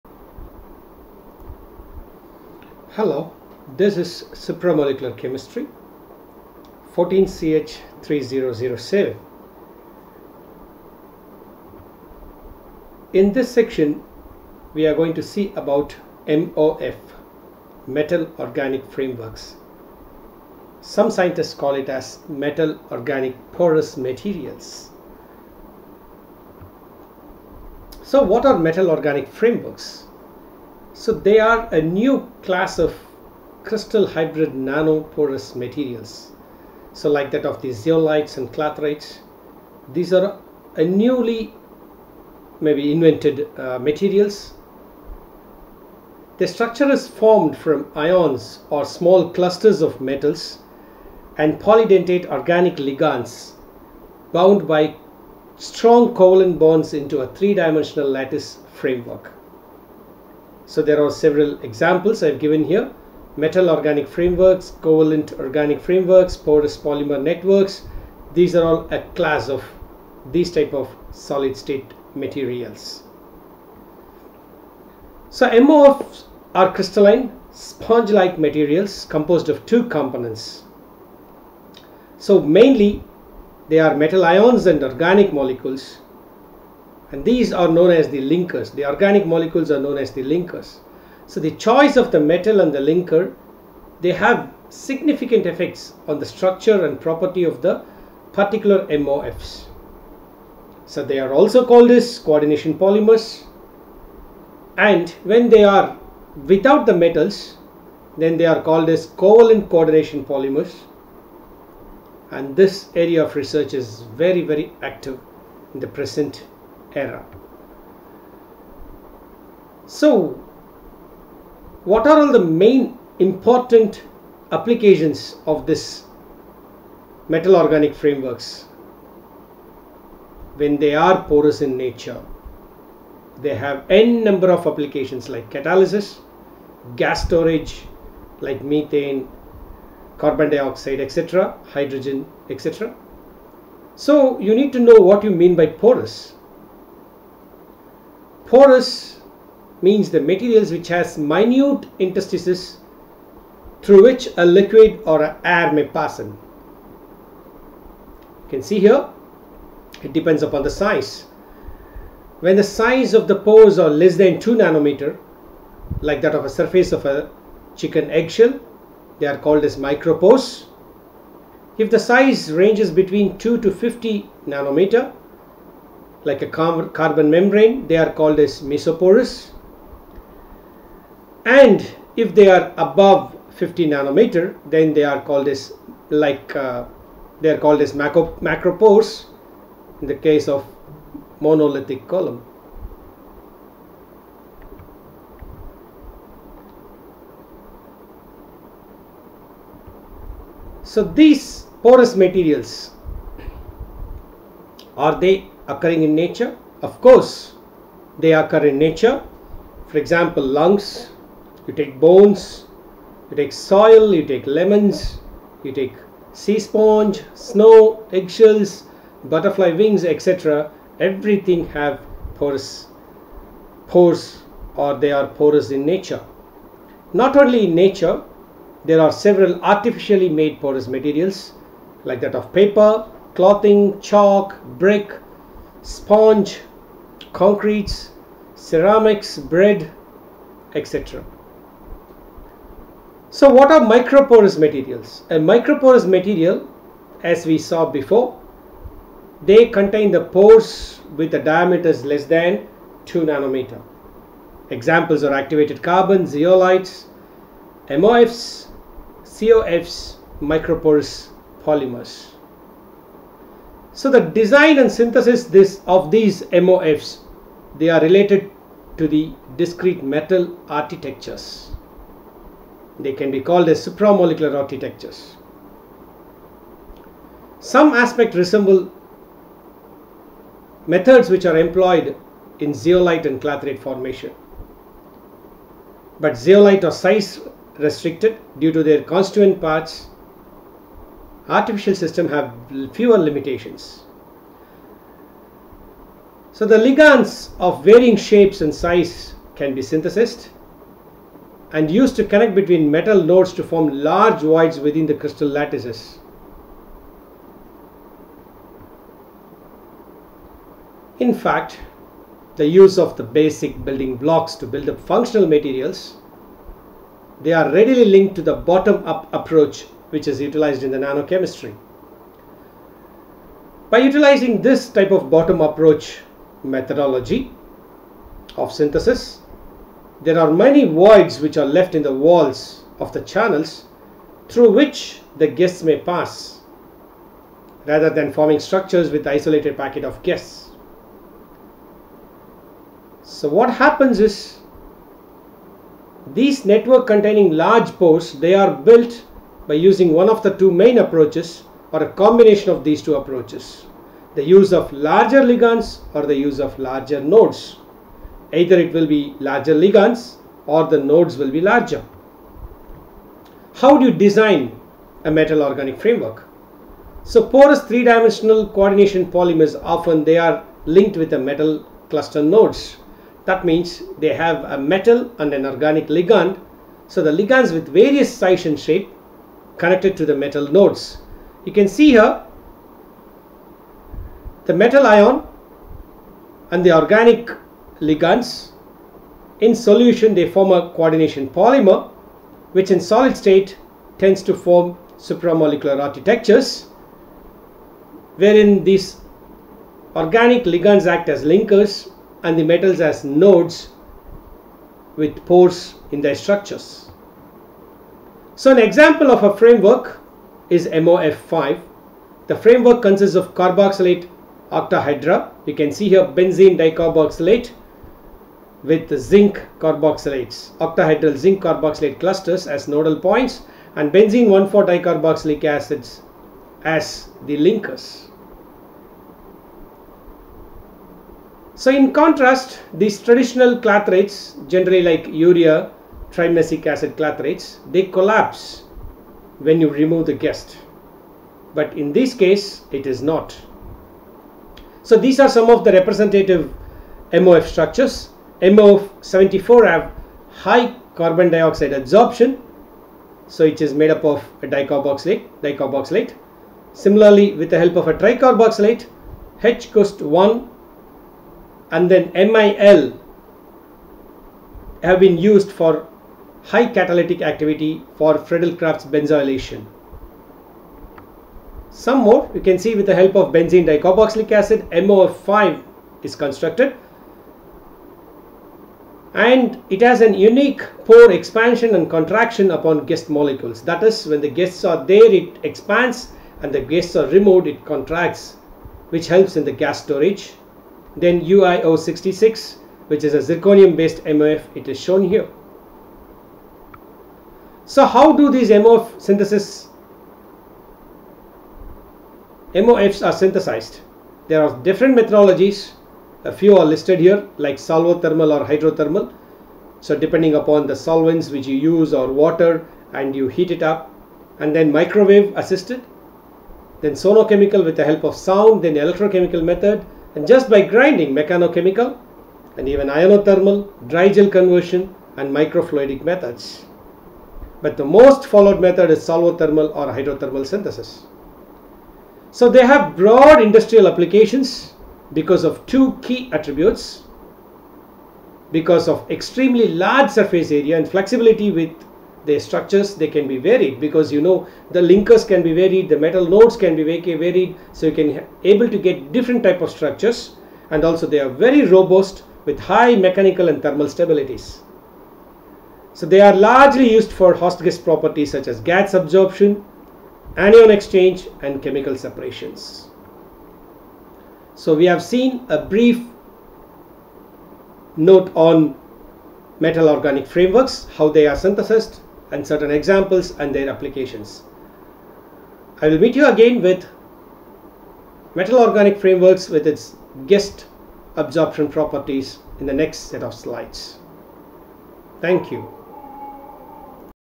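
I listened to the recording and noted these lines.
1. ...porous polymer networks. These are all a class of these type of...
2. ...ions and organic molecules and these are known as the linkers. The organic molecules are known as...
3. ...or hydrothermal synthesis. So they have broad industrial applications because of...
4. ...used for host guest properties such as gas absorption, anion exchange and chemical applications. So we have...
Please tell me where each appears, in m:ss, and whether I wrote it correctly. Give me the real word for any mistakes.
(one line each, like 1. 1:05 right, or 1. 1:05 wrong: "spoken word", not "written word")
1. 1:06 right
2. 1:24 right
3. 8:49 right
4. 9:17 wrong: "separations", not "applications".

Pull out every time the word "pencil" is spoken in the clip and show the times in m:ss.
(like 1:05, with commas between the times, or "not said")
not said.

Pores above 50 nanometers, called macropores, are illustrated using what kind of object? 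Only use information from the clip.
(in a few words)
monolithic column.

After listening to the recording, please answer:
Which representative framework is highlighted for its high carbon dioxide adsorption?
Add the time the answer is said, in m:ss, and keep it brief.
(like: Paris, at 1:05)
MOF 74, at 7:28.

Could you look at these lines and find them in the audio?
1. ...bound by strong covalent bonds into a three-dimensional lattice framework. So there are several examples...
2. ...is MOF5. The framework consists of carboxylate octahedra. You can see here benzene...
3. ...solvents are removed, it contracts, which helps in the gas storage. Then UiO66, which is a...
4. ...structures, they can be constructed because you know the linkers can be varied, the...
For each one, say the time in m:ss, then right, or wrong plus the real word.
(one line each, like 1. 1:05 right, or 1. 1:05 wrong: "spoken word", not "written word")
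1. 0:54 right
2. 6:50 right
3. 8:06 wrong: "guests", not "solvents"
4. 9:02 wrong: "varied", not "constructed".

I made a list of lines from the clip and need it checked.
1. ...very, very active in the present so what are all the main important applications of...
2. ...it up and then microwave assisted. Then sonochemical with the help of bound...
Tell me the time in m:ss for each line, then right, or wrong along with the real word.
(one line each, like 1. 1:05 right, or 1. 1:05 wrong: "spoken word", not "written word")
1. 1:54 right
2. 8:33 wrong: "sound", not "bound".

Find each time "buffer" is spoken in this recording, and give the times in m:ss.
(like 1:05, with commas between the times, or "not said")
not said.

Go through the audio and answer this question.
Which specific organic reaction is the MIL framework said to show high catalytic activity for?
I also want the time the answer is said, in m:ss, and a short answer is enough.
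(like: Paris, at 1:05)
Friedel-Crafts benzoylation, at 7:48.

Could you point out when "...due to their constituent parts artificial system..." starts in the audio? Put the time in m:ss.
4:48.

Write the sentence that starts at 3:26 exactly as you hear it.
Of course, they occur in nature.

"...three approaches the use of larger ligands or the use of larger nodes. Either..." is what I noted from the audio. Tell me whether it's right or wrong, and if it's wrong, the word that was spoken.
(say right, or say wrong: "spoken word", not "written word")
wrong: "two", not "three".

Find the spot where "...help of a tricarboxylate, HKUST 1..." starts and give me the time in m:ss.
7:37.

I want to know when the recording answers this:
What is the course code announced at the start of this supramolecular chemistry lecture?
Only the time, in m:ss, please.
0:06.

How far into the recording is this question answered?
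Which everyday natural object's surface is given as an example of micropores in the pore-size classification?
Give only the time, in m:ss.
2:47.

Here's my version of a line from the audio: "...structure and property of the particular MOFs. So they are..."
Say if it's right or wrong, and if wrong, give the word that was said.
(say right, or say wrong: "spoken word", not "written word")
right.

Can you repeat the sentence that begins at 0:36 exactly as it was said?
So like that of the zeolites and clathrates, these are a newly maybe invented uh, materials.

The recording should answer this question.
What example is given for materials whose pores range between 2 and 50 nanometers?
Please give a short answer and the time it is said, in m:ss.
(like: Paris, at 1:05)
carbon membrane, at 2:56.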